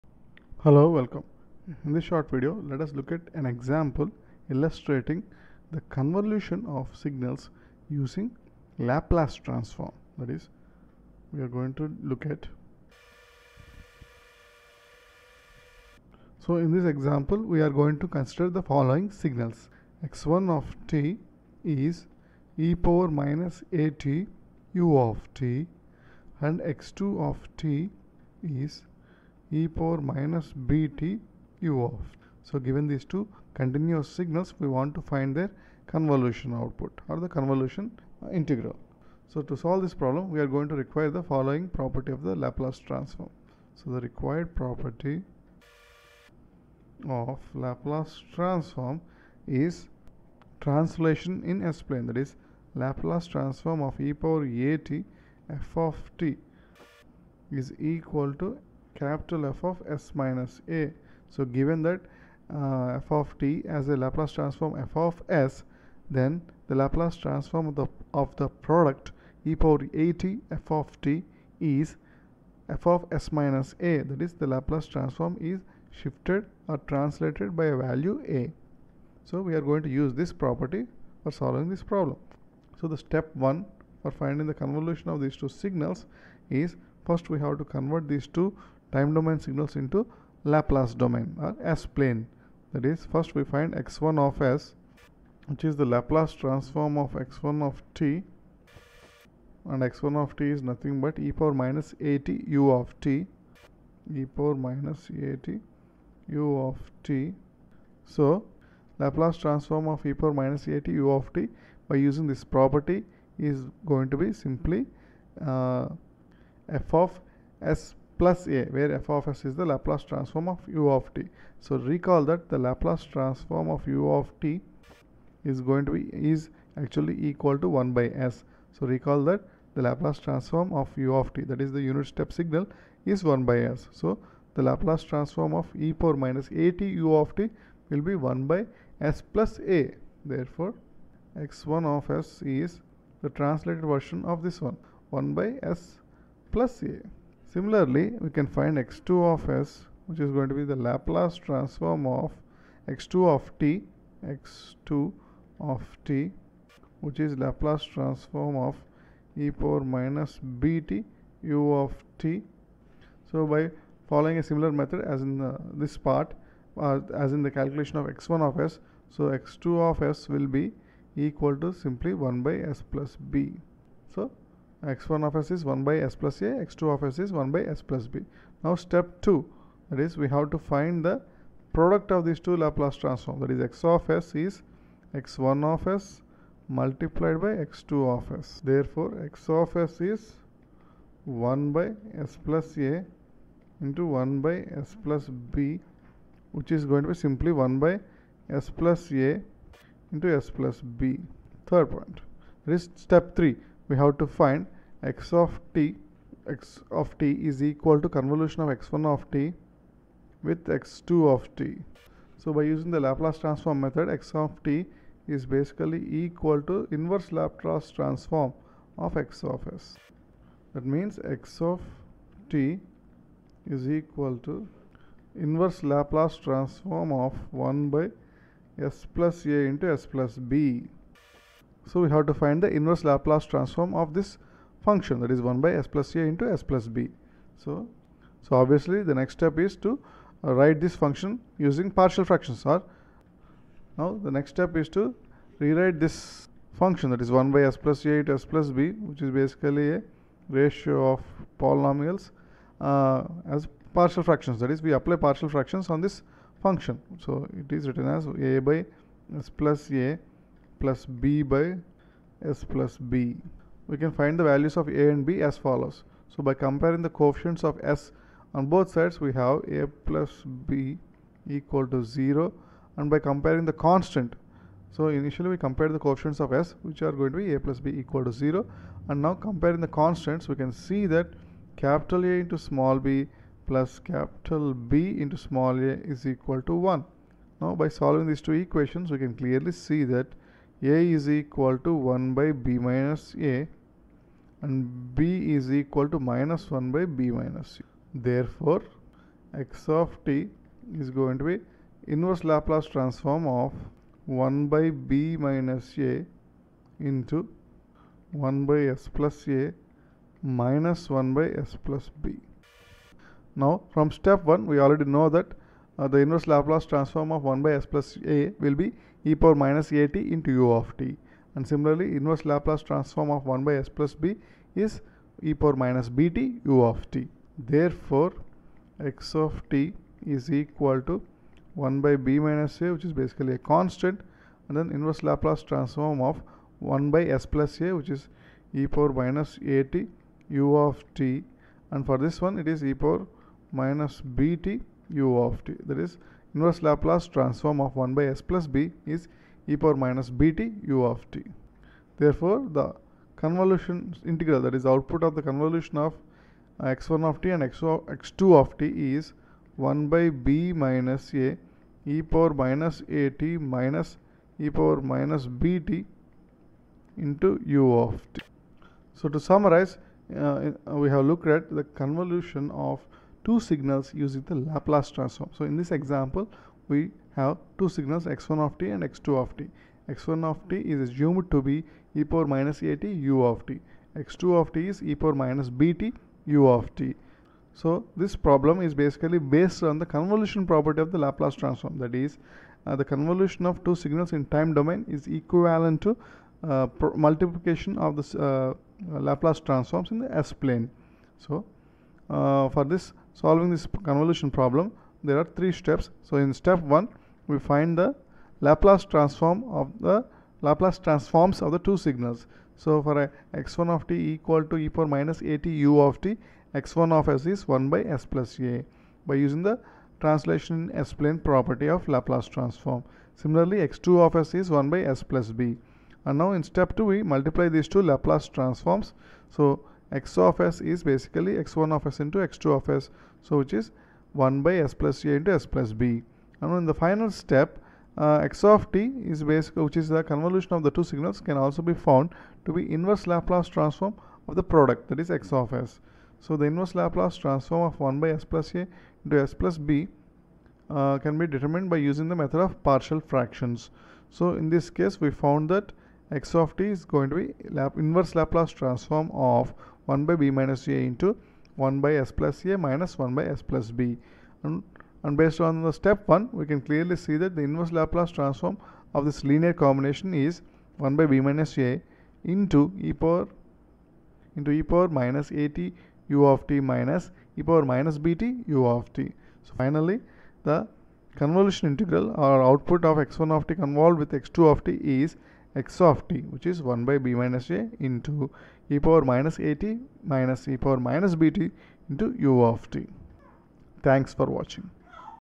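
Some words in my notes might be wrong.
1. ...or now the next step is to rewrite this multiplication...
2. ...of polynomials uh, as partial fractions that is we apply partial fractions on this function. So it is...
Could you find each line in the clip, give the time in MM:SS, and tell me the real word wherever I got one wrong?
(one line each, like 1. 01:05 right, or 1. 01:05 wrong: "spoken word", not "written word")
1. 04:02 wrong: "function", not "multiplication"
2. 04:11 right.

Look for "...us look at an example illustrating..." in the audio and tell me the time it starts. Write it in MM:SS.
00:02.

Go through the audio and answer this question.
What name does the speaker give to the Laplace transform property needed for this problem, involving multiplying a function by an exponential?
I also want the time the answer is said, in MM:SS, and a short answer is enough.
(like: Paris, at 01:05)
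Translation in S-plane, at 00:50.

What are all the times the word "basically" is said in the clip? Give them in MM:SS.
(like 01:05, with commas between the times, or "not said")
03:35, 04:09, 05:33, 06:28, 07:11, 07:19.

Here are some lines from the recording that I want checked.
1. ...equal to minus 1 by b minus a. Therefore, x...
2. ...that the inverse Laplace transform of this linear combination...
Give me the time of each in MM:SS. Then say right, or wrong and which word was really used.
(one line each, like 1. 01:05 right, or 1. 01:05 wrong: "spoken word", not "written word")
1. 04:55 right
2. 07:47 right.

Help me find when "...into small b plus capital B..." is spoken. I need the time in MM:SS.
04:42.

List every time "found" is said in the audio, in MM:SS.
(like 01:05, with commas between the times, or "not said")
07:21, 07:35.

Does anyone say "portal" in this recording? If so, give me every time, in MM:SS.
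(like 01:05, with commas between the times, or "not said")
not said.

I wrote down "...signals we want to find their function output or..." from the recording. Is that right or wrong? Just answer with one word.
wrong.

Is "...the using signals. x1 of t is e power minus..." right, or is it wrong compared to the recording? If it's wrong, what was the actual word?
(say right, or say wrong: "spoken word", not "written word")
wrong: "following", not "using".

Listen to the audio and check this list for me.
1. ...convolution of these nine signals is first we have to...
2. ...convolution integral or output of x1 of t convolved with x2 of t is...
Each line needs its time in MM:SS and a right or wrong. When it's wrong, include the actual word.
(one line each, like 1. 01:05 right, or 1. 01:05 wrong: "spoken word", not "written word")
1. 01:24 wrong: "two", not "nine"
2. 08:01 right.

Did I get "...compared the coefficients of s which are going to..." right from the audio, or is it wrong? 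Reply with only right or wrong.
right.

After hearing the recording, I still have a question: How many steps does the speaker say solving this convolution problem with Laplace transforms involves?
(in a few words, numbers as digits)
3.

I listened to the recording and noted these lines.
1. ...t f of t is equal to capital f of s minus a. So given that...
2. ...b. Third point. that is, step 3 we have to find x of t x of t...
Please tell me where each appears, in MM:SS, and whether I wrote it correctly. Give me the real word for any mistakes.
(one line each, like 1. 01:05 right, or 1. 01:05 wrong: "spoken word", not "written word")
1. 00:54 right
2. 03:20 right.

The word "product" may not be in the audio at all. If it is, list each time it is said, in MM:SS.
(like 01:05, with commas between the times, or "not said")
01:08, 03:01, 07:24.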